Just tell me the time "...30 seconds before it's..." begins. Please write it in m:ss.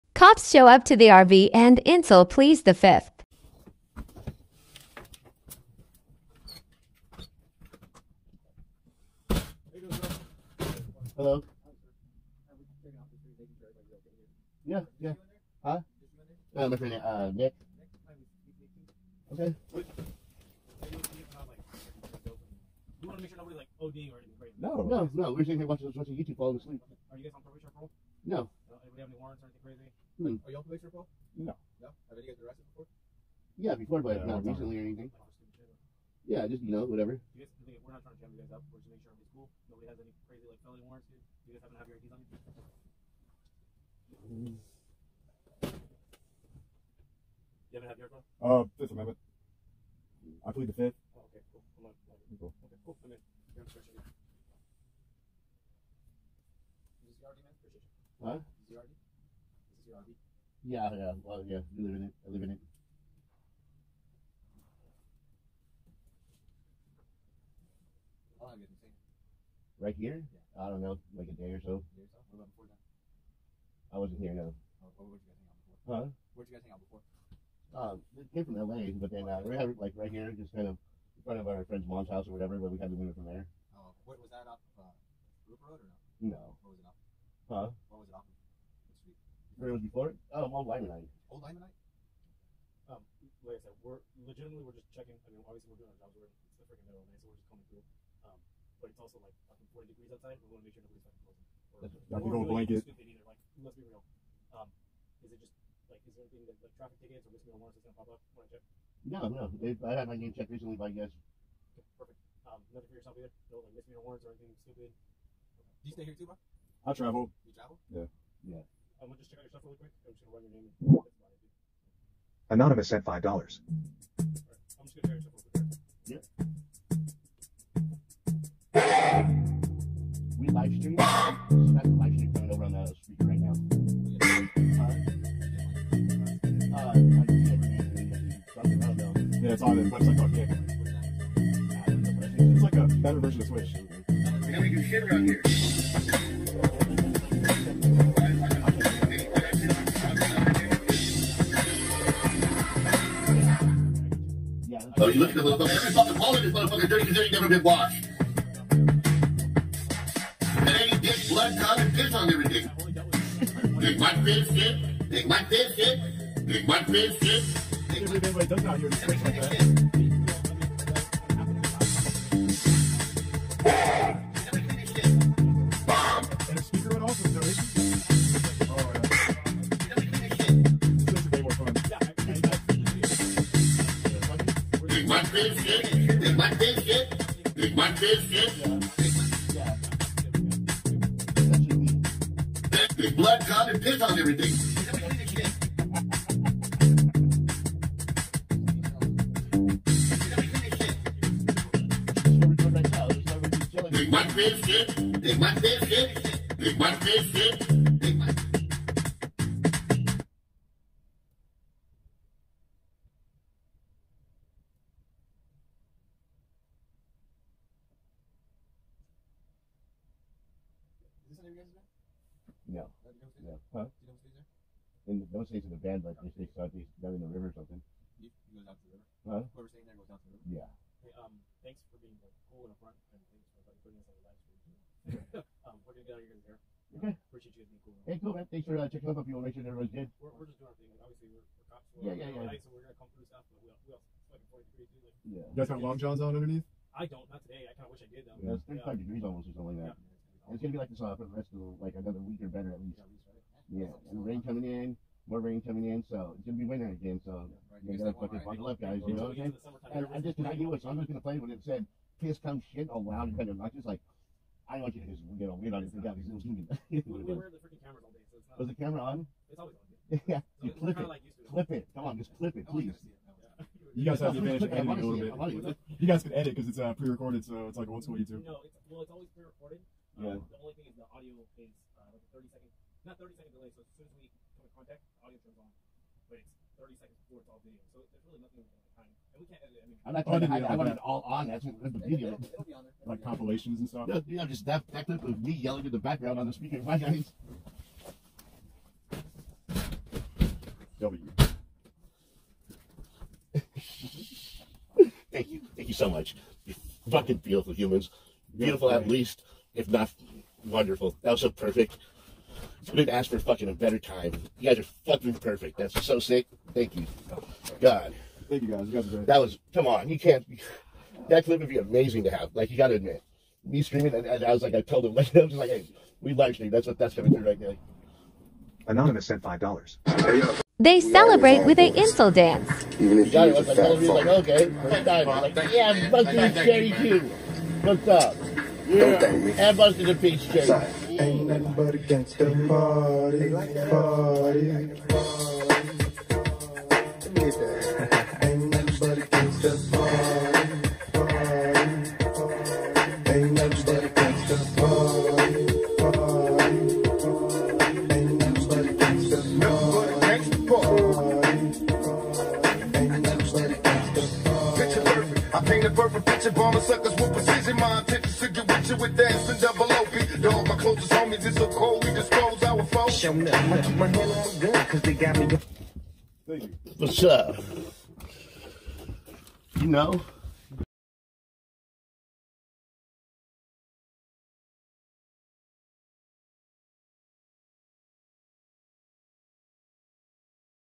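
4:46.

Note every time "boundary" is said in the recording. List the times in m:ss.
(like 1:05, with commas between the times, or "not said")
not said.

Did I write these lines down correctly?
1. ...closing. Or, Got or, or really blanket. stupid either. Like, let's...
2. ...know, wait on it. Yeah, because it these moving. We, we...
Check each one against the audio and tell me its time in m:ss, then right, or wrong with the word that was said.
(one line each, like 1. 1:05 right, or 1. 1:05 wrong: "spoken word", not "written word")
1. 1:41 right
2. 4:25 right.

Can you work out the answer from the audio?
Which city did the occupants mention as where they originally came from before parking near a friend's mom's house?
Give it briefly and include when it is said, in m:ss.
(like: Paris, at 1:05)
LA, at 1:18.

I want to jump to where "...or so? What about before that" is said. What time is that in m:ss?
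1:12.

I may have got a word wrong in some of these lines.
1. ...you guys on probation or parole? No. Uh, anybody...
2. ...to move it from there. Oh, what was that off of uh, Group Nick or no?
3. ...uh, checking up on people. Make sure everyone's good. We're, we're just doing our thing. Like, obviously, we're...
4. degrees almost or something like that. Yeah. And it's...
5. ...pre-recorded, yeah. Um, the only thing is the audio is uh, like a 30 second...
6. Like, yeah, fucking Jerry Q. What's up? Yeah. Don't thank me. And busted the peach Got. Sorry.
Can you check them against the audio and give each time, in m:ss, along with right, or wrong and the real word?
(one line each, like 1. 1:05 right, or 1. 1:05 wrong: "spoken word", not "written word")
1. 0:27 right
2. 1:22 wrong: "Road", not "Nick"
3. 3:58 right
4. 4:09 right
5. 4:39 right
6. 5:35 wrong: "Jay", not "Got".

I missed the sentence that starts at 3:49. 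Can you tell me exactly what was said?
Whoever's staying there goes out to the river?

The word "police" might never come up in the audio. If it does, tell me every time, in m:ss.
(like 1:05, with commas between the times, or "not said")
0:30.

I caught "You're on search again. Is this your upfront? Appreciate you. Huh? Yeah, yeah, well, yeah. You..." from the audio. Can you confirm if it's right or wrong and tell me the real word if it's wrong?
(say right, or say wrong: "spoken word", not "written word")
wrong: "argument", not "upfront".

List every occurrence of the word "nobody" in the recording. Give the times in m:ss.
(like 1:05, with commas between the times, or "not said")
0:39, 1:40.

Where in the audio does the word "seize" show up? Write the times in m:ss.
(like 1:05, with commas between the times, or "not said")
not said.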